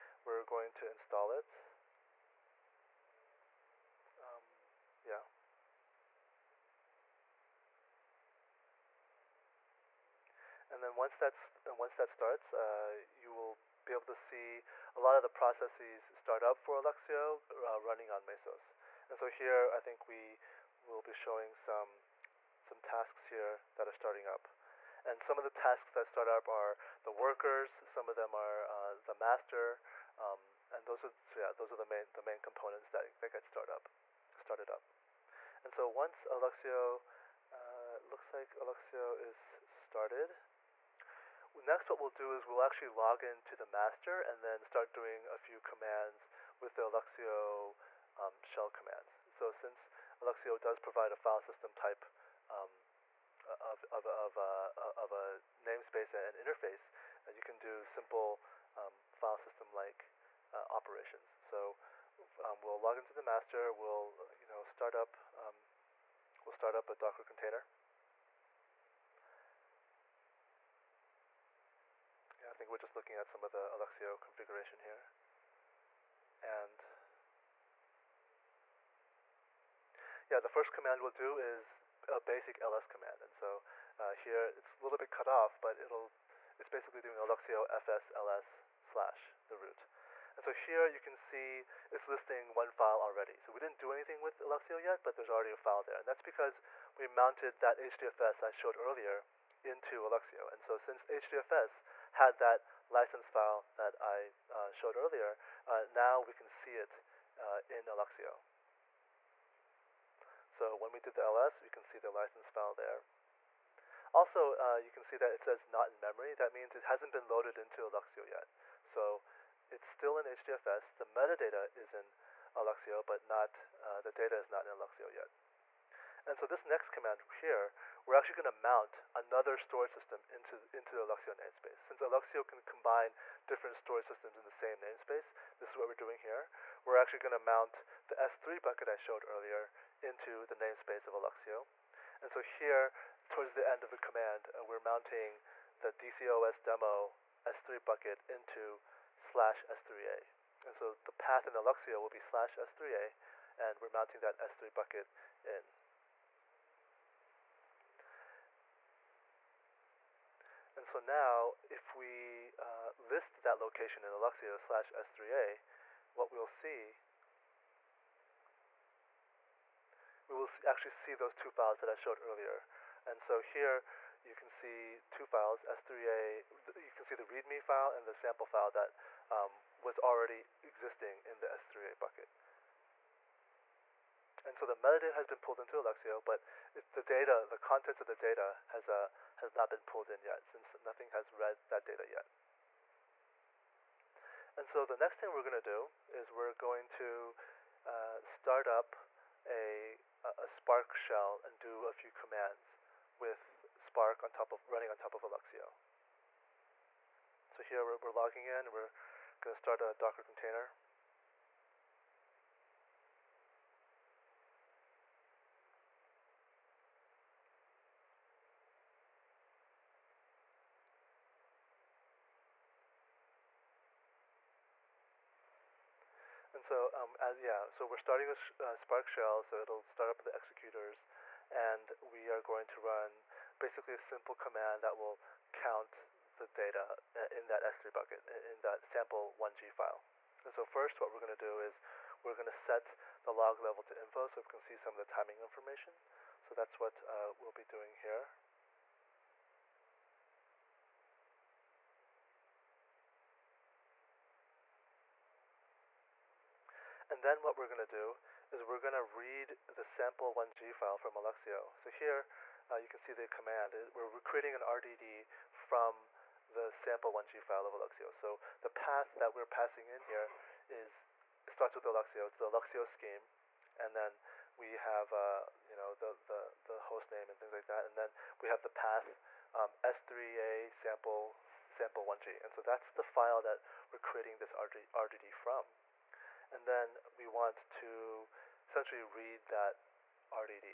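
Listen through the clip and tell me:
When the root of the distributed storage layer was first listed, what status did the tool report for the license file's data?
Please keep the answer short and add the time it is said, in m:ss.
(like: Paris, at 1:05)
not in memory, at 1:55.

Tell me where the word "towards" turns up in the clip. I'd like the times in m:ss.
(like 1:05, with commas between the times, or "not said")
2:23.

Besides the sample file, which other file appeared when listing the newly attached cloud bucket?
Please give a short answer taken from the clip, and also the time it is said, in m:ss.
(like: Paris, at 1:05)
README, at 2:57.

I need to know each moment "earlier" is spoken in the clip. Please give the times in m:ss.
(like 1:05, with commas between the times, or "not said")
1:38, 1:44, 2:19, 2:52.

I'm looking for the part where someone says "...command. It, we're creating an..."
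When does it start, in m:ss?
4:23.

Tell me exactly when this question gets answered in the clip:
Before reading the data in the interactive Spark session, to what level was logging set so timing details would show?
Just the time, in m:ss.
4:03.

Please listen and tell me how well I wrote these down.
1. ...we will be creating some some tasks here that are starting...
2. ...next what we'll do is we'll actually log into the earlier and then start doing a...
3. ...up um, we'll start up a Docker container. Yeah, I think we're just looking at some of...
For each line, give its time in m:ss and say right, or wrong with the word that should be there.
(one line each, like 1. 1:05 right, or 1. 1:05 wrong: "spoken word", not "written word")
1. 0:20 wrong: "showing", not "creating"
2. 0:41 wrong: "master", not "earlier"
3. 1:04 right.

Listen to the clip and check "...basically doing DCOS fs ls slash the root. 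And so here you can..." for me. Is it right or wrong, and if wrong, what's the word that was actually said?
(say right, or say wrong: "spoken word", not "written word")
wrong: "Alluxio", not "DCOS".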